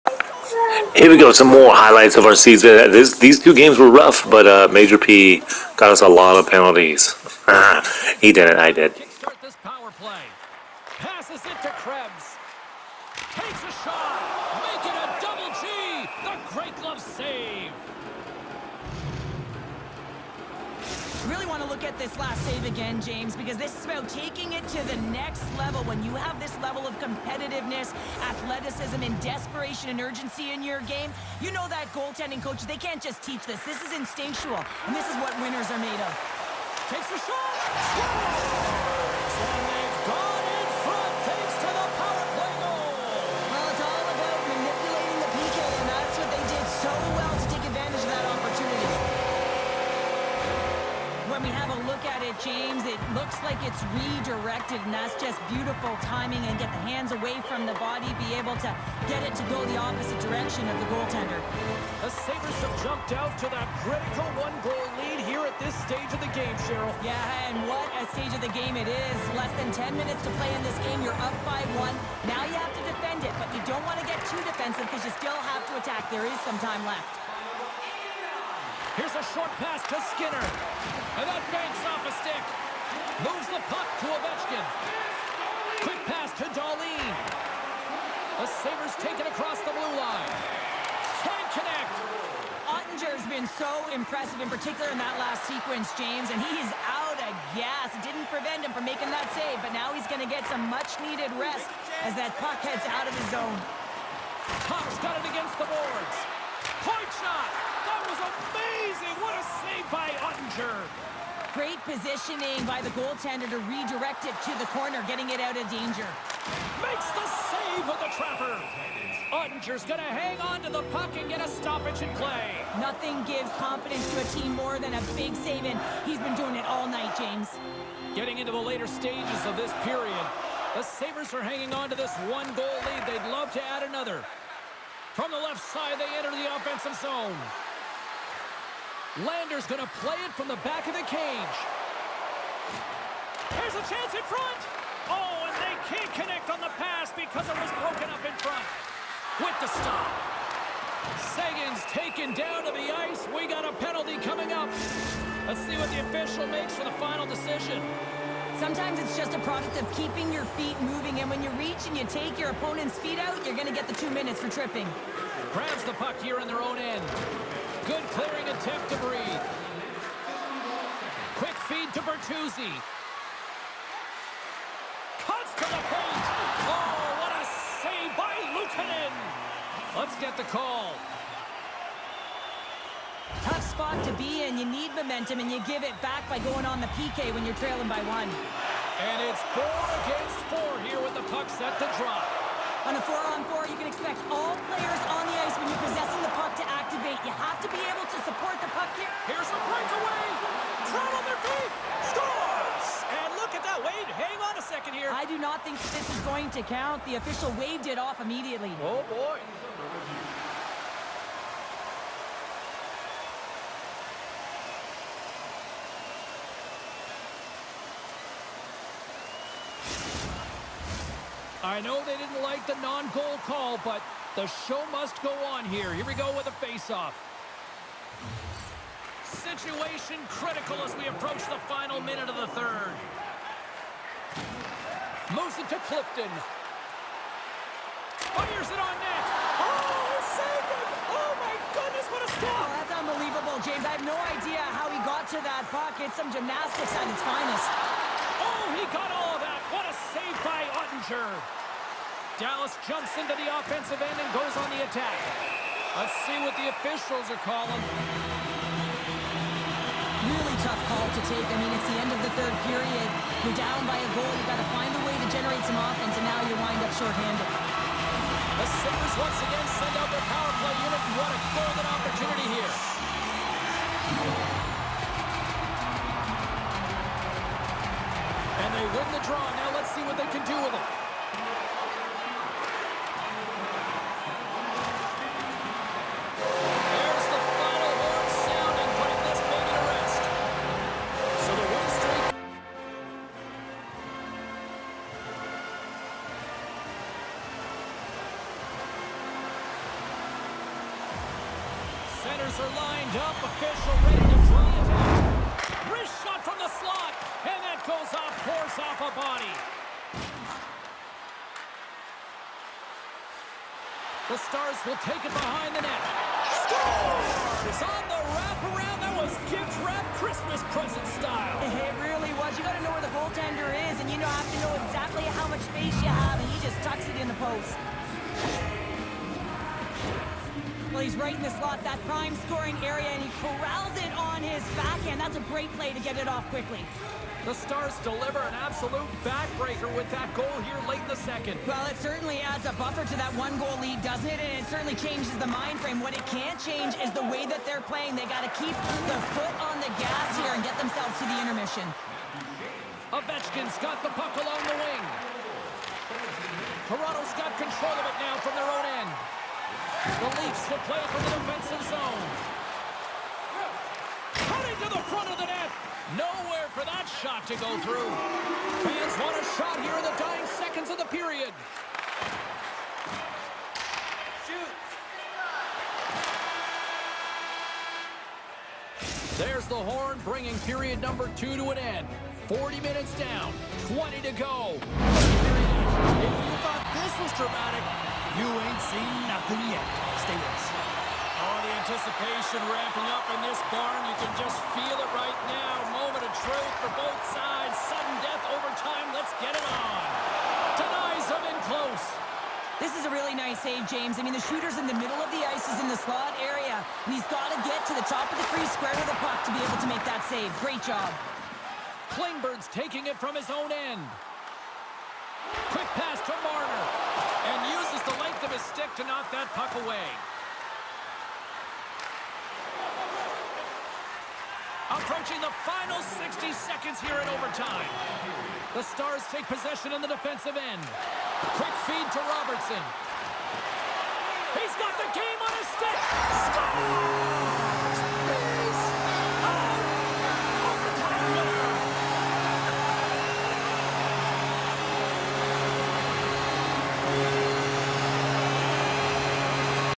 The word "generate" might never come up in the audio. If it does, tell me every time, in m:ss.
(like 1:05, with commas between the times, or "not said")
4:25.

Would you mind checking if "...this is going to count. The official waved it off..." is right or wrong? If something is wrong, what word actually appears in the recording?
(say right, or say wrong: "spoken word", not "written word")
right.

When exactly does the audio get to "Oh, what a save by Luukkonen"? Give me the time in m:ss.
2:56.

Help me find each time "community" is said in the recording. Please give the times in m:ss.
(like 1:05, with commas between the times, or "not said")
not said.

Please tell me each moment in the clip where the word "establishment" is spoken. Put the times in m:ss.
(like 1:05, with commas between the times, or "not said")
not said.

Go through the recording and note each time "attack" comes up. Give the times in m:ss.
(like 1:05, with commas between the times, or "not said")
1:15, 4:14.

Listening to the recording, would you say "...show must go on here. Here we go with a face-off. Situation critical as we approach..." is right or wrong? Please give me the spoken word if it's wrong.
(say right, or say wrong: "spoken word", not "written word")
right.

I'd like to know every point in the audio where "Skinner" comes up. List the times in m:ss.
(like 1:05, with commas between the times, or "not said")
1:20.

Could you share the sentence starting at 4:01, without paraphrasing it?
Oh, my goodness, what a stop.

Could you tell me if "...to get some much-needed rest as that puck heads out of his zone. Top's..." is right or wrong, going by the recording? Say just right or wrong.
right.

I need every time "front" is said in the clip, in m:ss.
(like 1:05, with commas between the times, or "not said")
2:24, 2:28, 6:05.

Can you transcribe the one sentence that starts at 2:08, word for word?
Getting into the later stages of this period, the Sabres are hanging on to this one-goal lead.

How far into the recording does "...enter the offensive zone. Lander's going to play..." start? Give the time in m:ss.
2:16.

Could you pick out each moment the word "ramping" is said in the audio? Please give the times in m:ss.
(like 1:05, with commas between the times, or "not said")
6:32.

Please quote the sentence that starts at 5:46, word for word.
What it can't change is the way that they're playing.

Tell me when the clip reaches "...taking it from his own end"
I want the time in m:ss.
6:52.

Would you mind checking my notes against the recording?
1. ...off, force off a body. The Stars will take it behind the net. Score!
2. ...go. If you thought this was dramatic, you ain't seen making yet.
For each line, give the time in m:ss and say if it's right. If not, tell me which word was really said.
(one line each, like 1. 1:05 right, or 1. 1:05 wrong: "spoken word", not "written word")
1. 5:08 right
2. 6:24 wrong: "nothing", not "making".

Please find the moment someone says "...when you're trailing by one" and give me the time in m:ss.
3:07.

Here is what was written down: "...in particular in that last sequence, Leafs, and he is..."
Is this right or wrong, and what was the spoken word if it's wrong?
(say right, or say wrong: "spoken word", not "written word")
wrong: "James", not "Leafs".